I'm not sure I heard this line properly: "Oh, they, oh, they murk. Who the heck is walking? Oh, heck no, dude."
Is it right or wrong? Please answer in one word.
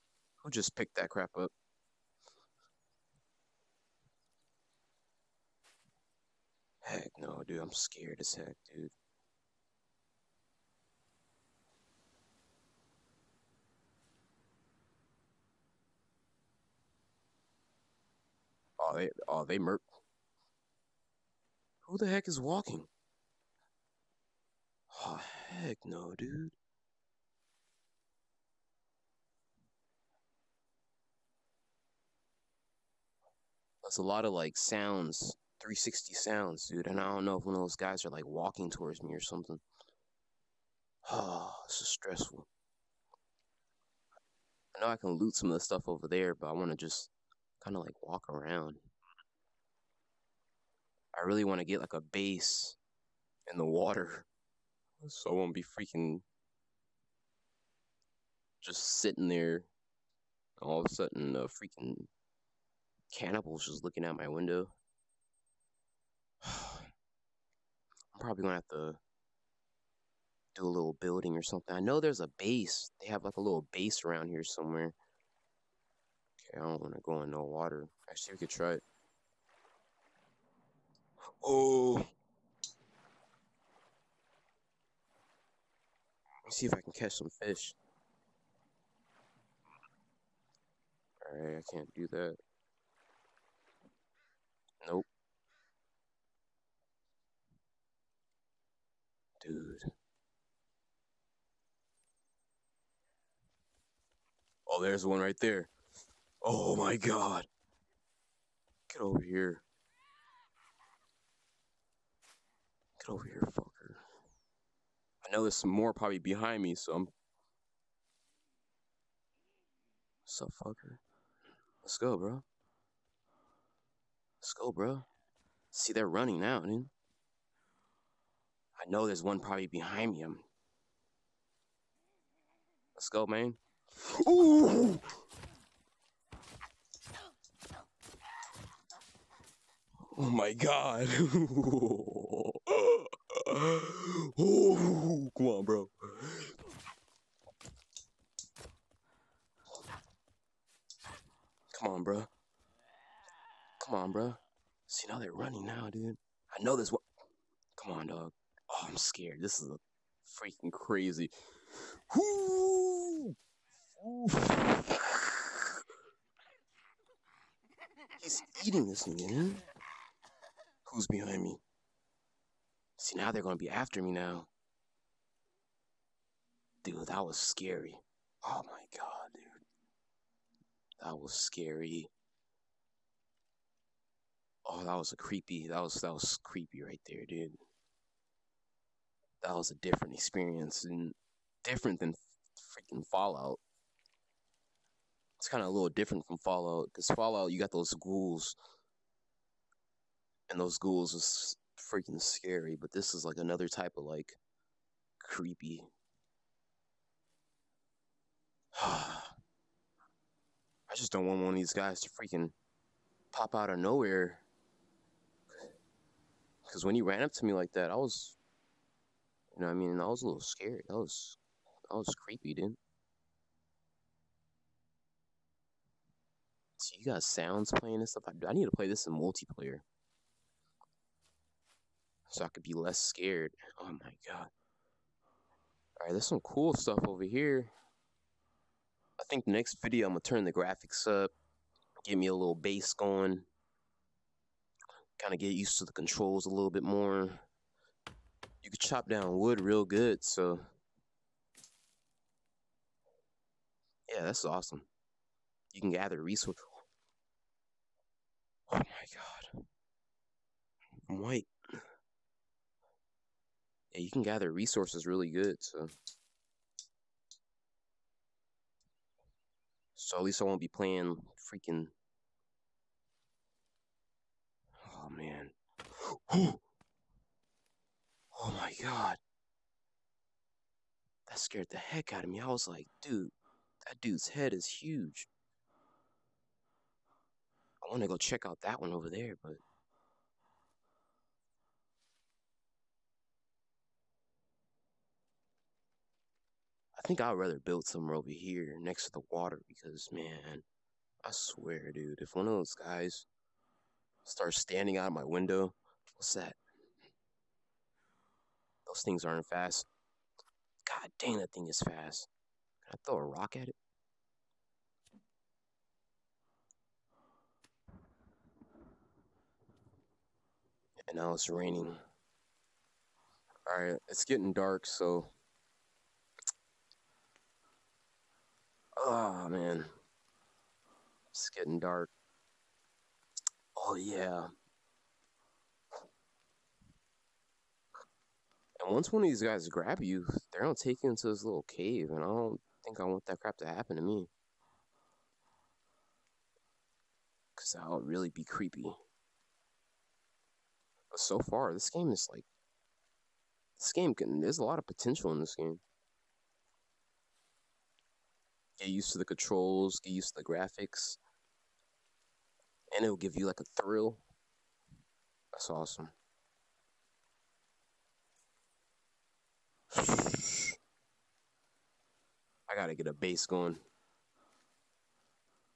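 right.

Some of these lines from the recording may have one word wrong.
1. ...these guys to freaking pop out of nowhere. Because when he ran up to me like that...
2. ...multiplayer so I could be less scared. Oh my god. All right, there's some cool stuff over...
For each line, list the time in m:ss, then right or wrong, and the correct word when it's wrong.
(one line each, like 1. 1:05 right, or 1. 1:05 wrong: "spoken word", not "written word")
1. 3:31 right
2. 3:49 right.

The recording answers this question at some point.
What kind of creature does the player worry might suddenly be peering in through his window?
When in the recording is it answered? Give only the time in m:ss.
1:03.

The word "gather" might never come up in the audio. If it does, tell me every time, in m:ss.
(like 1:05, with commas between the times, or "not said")
4:15, 4:24.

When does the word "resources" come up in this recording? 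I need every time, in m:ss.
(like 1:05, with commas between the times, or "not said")
4:16, 4:24.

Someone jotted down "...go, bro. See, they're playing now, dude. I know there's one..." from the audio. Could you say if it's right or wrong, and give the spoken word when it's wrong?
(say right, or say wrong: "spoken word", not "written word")
wrong: "running", not "playing".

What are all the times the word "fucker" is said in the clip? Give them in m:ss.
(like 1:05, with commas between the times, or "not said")
1:53, 2:00.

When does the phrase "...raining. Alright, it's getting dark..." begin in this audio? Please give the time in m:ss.
5:21.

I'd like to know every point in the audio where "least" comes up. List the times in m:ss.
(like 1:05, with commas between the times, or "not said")
4:30.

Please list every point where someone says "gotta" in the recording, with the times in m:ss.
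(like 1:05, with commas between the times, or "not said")
6:12.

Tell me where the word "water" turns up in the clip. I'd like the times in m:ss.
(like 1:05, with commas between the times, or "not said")
0:53, 1:17, 4:59.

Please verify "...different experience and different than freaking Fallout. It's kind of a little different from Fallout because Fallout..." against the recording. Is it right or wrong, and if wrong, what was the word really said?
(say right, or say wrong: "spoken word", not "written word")
right.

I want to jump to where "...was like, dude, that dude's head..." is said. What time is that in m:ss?
4:42.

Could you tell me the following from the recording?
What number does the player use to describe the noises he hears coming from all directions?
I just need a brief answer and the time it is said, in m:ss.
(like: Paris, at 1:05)
360, at 0:35.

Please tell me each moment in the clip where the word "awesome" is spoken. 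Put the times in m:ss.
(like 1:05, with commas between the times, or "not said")
4:14, 6:05.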